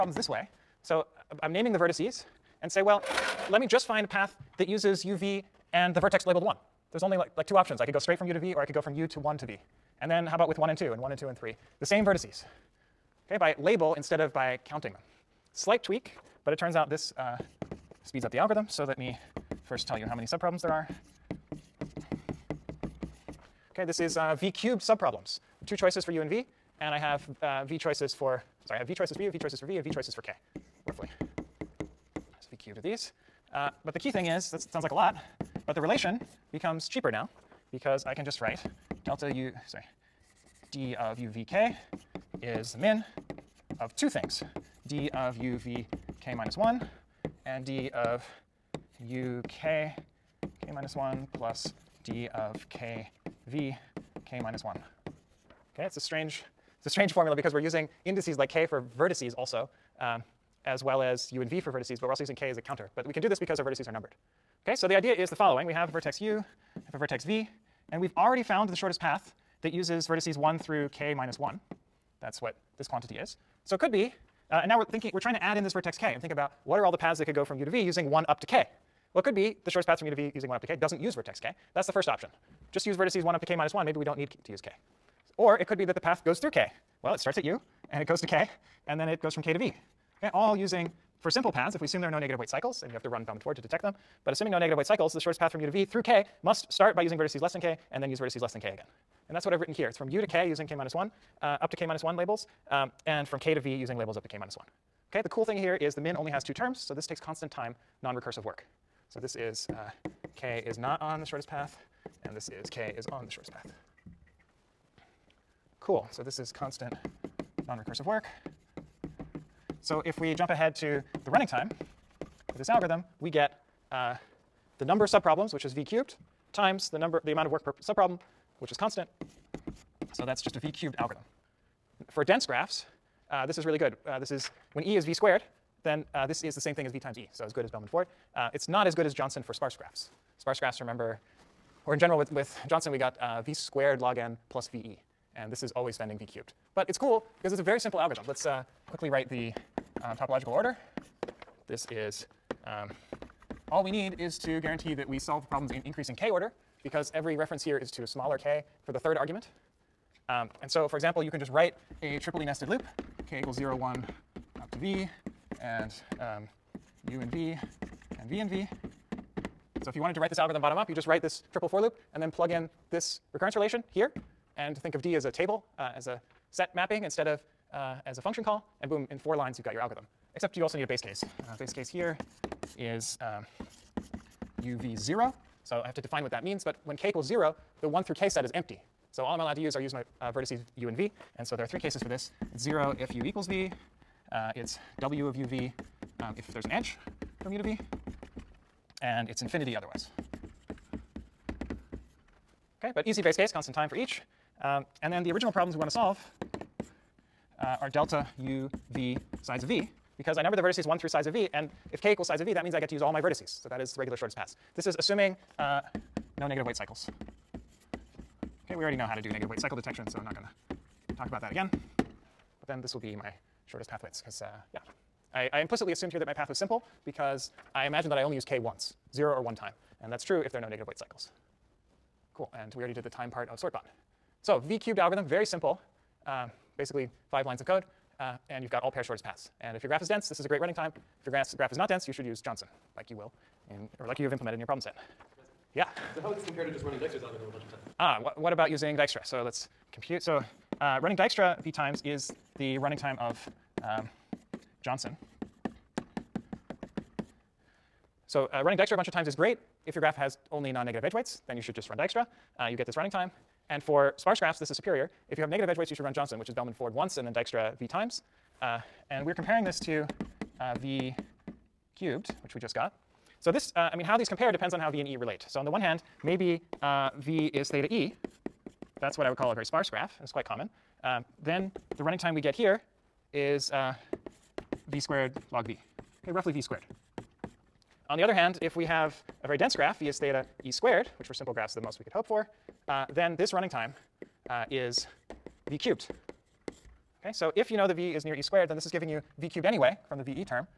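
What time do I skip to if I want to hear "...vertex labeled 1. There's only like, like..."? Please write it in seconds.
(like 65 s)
5 s.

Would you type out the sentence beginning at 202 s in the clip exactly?
Okay, but easy base case, constant time for each.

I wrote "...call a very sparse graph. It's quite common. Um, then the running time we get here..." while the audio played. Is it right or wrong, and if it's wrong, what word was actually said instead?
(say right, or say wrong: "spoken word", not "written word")
right.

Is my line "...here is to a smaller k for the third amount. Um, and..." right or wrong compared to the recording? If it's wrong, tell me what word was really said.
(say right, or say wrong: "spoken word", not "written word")
wrong: "argument", not "amount".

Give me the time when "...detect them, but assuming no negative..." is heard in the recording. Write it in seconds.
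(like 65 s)
93 s.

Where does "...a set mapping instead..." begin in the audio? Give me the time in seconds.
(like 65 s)
176 s.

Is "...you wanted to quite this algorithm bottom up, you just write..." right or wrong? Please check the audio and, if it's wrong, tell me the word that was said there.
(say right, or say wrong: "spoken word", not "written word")
wrong: "write", not "quite".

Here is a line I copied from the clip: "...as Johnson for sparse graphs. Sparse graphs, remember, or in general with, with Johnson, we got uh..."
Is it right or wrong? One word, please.
right.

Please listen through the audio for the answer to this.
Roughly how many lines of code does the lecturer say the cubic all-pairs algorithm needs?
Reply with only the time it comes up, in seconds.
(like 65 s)
237 s.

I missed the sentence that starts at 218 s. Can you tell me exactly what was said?
Okay, we already know how to do negative weight cycle detection, so I'm not going to talk about that again.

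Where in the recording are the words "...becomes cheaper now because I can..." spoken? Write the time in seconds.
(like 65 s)
36 s.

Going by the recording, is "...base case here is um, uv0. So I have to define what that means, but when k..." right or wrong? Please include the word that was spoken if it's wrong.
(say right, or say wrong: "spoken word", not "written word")
right.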